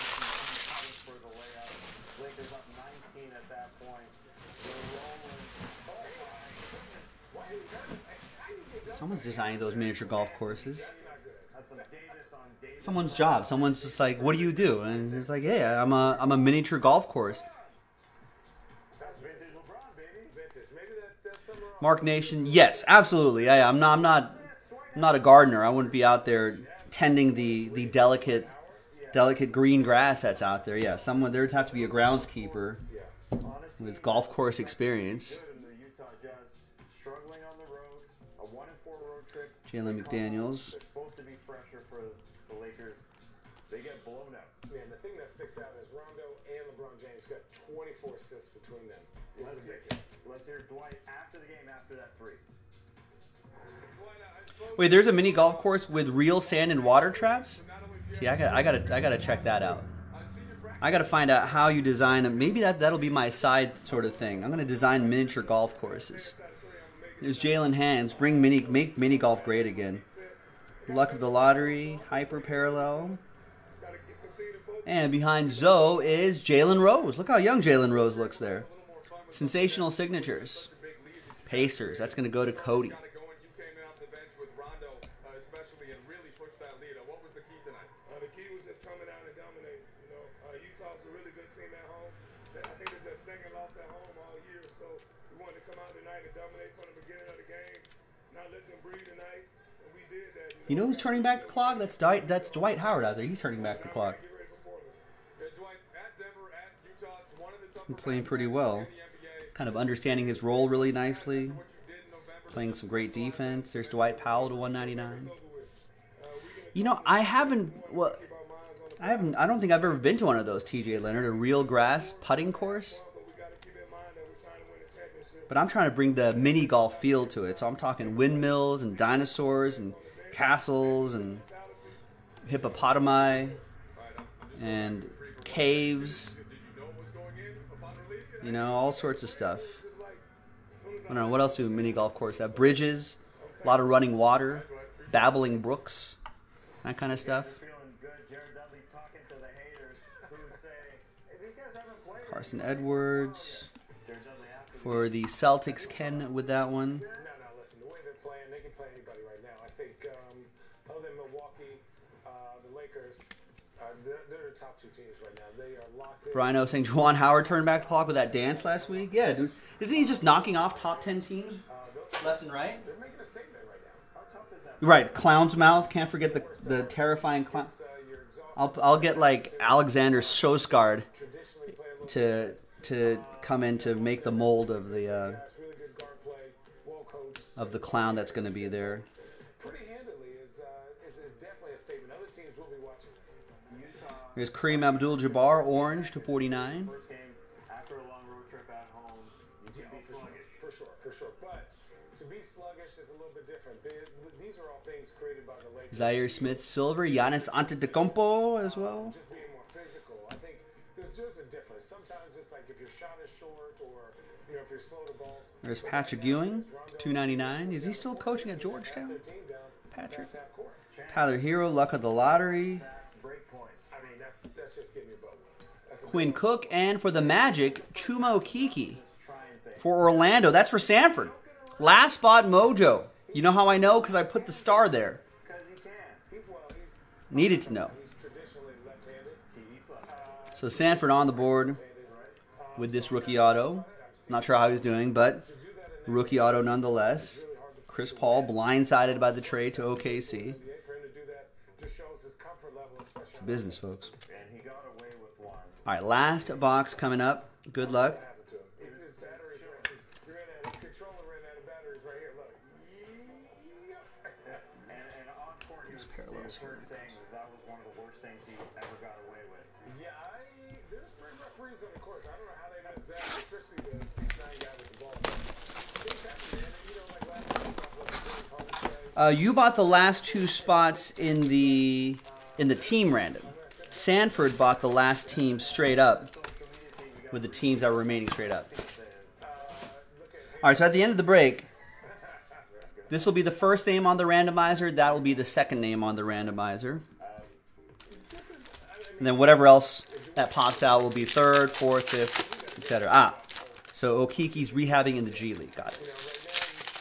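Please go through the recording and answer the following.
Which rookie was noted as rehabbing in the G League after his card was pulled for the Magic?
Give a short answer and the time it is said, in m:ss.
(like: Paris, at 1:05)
Chuma Okeke, at 3:47.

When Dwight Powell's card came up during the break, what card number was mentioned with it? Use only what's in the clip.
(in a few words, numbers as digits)
199.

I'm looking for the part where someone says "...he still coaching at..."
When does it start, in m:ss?
3:37.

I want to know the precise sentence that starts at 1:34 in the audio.
So we wanted to come out tonight and dominate from the beginning of the game, not let them breathe tonight.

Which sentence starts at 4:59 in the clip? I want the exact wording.
And then whatever else that pops out will be third, fourth, fifth, etc.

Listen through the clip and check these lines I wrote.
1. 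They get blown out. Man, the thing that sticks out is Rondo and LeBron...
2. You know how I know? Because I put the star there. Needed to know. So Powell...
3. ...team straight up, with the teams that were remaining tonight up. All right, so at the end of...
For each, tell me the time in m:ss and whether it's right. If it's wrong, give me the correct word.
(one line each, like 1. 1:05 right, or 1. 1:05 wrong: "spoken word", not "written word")
1. 0:43 right
2. 3:53 wrong: "Sanford", not "Powell"
3. 4:45 wrong: "straight", not "tonight".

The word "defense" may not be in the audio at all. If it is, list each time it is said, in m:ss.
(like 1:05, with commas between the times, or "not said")
1:53.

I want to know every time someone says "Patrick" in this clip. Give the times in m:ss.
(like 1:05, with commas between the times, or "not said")
3:35, 3:39.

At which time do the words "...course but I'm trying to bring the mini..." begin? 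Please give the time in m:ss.
2:02.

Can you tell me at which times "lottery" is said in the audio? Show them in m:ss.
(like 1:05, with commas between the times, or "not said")
1:11, 3:42.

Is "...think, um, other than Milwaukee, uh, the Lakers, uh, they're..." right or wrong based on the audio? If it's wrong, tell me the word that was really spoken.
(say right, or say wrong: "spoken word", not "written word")
right.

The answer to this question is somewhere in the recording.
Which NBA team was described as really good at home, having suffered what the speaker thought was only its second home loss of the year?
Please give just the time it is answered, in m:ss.
1:30.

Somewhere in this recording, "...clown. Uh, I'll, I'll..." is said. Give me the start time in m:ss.
2:57.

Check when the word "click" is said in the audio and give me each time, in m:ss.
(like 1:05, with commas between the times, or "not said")
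not said.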